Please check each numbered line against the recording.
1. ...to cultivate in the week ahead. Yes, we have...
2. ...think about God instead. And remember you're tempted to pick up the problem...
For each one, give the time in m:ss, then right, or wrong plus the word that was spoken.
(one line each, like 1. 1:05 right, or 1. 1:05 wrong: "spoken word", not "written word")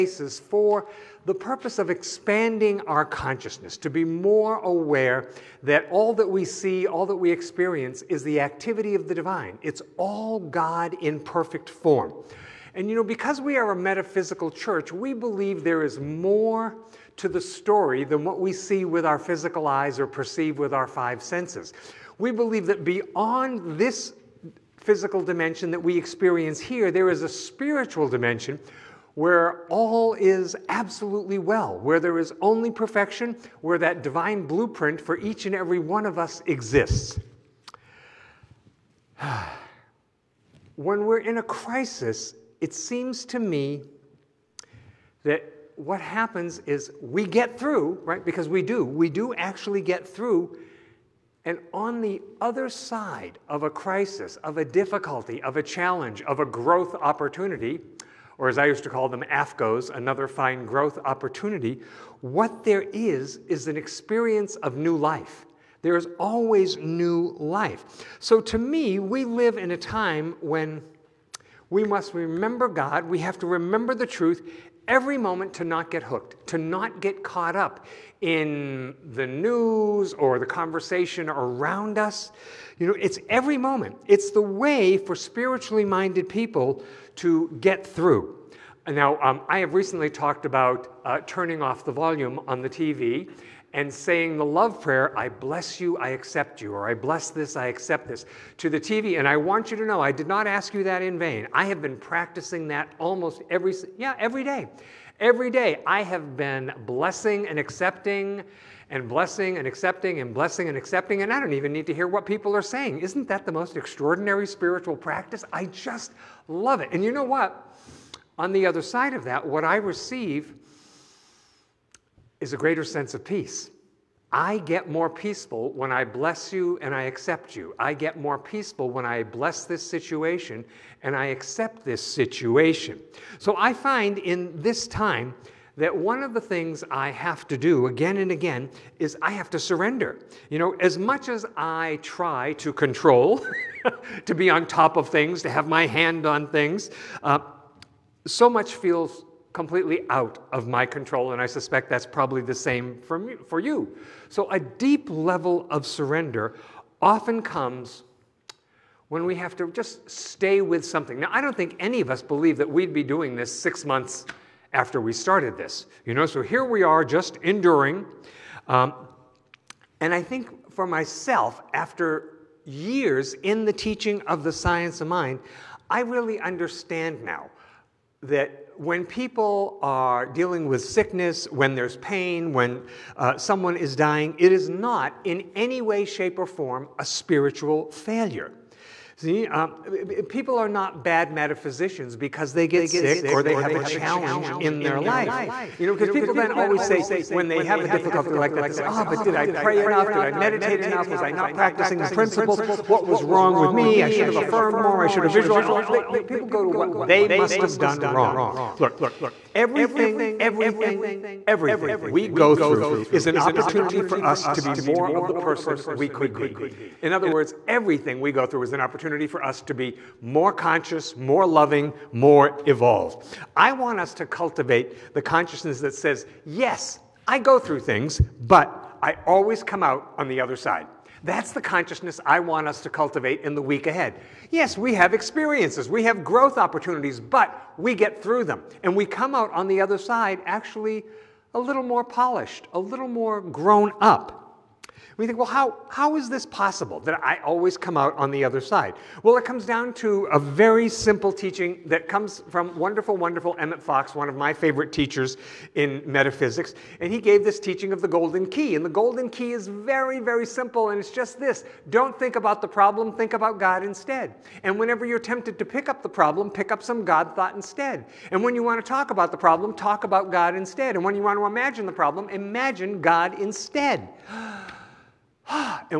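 1. 3:52 right
2. 4:23 wrong: "whenever", not "remember".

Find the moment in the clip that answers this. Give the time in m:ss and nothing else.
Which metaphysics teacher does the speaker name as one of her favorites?
4:13.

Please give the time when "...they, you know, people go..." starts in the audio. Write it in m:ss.
3:25.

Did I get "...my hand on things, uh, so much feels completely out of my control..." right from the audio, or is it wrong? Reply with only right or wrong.
right.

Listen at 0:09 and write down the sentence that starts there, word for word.
It's all God in perfect form.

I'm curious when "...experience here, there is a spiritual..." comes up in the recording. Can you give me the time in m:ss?
0:25.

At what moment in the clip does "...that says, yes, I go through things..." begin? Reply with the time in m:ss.
3:45.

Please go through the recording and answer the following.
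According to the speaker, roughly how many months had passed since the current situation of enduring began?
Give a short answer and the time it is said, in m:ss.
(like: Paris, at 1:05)
6, at 2:43.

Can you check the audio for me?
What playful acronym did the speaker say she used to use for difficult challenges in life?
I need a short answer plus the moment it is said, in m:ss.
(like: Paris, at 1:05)
AFGOs, at 0:59.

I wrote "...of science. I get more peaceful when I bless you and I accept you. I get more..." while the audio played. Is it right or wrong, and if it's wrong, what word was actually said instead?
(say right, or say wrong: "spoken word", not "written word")
wrong: "peace", not "science".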